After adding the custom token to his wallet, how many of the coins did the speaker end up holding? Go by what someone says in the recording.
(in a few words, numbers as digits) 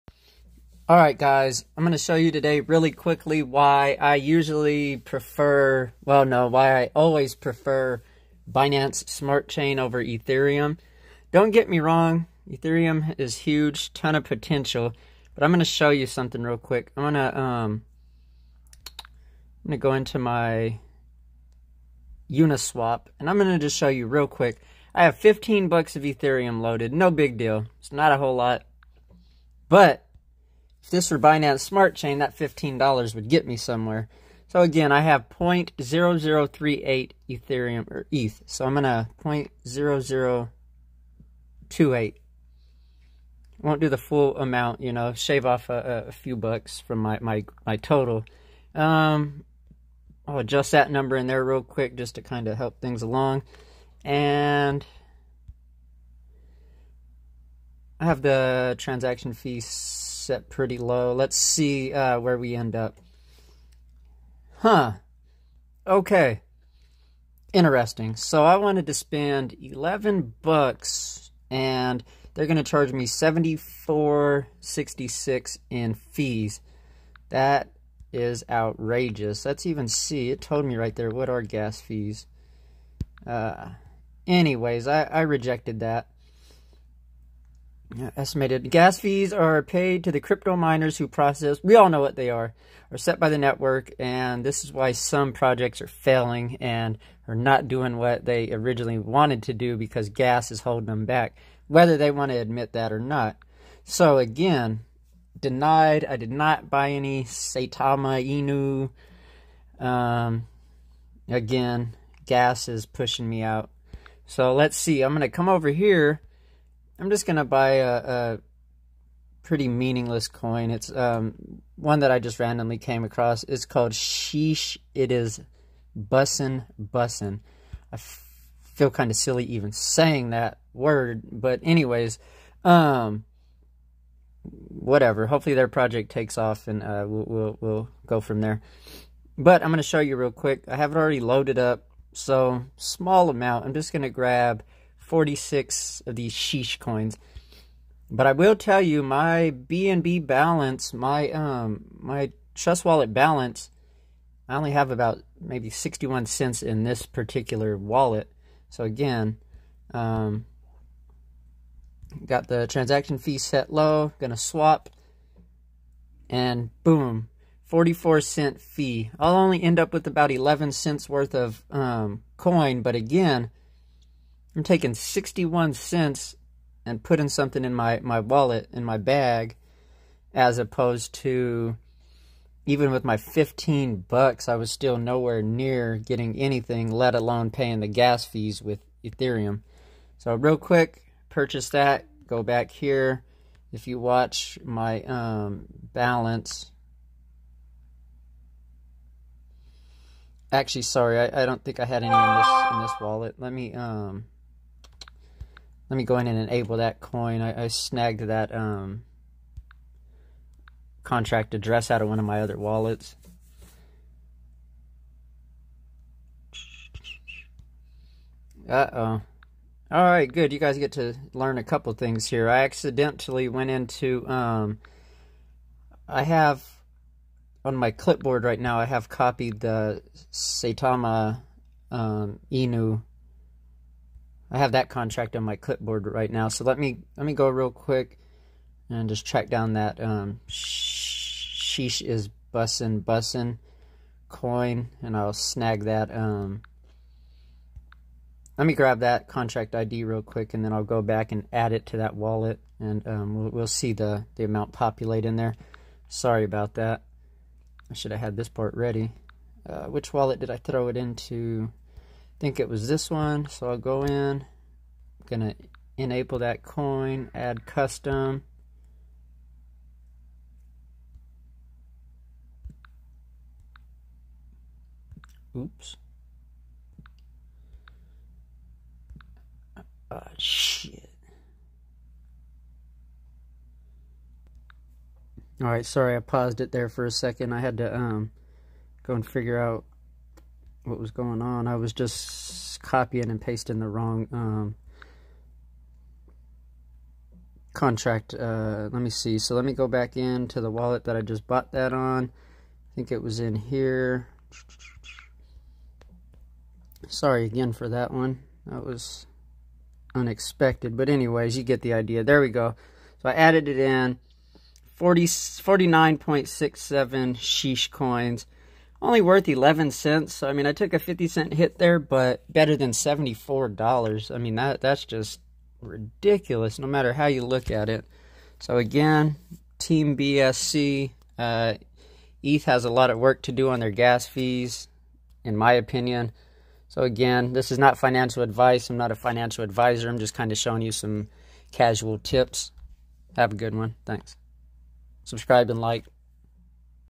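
49.67.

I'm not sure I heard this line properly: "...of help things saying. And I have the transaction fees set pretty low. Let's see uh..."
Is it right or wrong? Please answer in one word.
wrong.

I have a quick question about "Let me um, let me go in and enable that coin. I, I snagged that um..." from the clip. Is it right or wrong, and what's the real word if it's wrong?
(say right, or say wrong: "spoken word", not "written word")
right.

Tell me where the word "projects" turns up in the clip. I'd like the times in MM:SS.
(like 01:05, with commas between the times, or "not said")
01:35, 02:15.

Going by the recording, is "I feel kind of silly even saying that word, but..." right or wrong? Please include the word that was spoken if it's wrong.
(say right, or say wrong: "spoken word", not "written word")
right.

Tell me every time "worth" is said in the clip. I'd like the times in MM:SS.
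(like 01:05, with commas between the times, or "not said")
02:51, 05:19.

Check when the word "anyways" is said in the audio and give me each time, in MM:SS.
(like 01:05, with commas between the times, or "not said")
01:24, 02:11, 05:11.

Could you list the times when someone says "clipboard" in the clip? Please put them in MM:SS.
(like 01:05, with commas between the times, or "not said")
03:47, 03:55.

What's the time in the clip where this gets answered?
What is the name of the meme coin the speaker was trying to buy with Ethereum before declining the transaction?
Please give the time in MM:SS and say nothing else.
01:47.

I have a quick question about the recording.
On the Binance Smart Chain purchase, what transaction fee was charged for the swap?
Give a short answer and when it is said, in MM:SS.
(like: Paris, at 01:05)
44 cents, at 02:47.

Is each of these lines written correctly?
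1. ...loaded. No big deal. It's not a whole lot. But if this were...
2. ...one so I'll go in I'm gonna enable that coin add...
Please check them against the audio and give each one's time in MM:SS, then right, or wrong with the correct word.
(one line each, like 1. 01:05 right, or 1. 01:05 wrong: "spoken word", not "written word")
1. 00:26 right
2. 04:23 right.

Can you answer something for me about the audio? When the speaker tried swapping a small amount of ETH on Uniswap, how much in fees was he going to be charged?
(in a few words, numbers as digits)
$74.66.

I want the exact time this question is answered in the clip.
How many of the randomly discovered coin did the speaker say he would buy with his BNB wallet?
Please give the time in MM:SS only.
02:25.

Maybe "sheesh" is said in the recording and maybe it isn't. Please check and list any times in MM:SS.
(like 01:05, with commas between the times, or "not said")
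02:03, 02:26, 04:00, 05:17.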